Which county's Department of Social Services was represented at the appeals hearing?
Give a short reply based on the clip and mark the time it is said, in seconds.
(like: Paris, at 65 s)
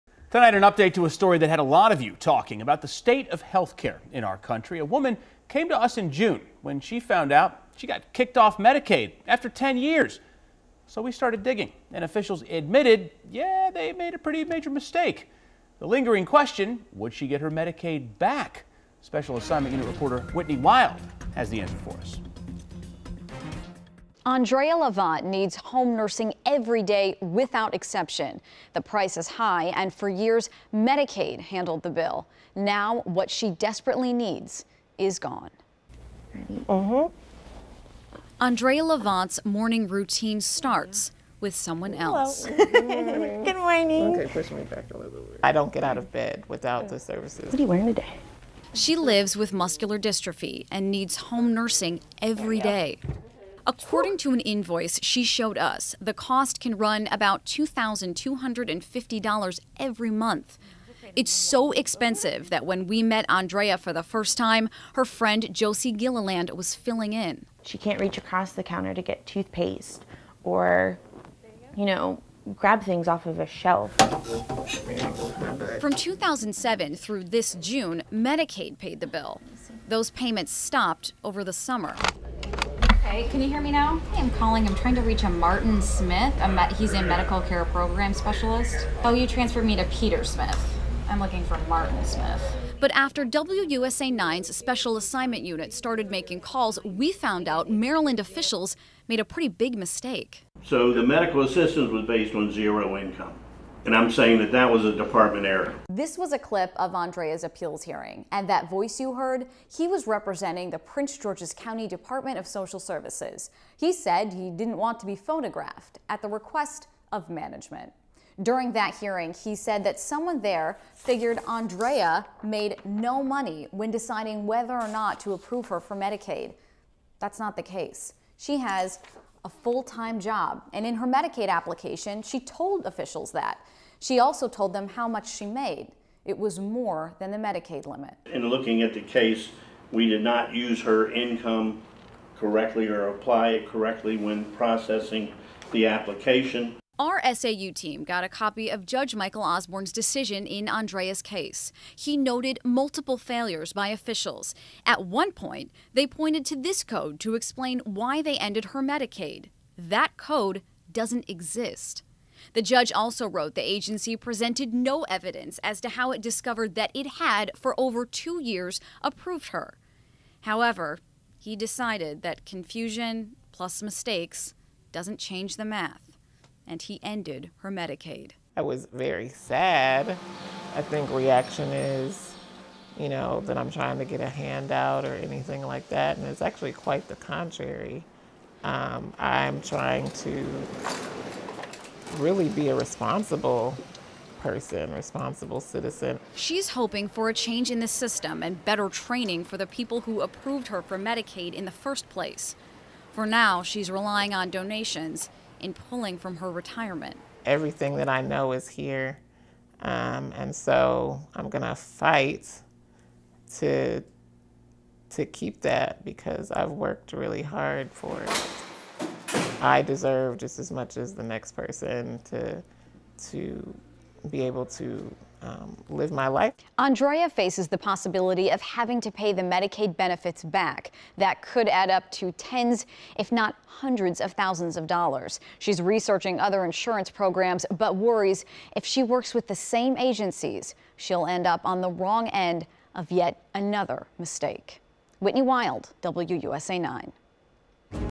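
Prince George's County, at 110 s.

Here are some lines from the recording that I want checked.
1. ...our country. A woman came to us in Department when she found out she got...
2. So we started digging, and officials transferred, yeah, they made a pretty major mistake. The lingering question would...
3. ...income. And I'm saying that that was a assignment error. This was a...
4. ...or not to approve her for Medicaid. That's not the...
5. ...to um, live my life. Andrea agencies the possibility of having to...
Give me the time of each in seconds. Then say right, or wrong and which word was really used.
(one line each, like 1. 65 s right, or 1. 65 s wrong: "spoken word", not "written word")
1. 4 s wrong: "June", not "Department"
2. 10 s wrong: "admitted", not "transferred"
3. 102 s wrong: "department", not "assignment"
4. 124 s right
5. 224 s wrong: "faces", not "agencies".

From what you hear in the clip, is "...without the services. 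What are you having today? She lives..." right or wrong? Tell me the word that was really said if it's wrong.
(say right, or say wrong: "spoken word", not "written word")
wrong: "wearing", not "having".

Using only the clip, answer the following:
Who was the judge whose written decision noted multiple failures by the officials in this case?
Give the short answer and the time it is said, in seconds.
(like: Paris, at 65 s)
Michael Osborne, at 149 s.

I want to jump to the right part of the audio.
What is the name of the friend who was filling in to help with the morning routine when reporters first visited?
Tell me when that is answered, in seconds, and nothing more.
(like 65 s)
65 s.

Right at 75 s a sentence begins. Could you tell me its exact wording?
From 2007 through this June, Medicaid paid the bill.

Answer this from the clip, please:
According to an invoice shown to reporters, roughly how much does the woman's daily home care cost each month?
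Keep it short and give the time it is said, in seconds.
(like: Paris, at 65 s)
$2,250, at 57 s.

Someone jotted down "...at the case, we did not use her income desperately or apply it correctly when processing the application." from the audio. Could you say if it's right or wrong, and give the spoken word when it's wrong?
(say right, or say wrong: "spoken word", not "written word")
wrong: "correctly", not "desperately".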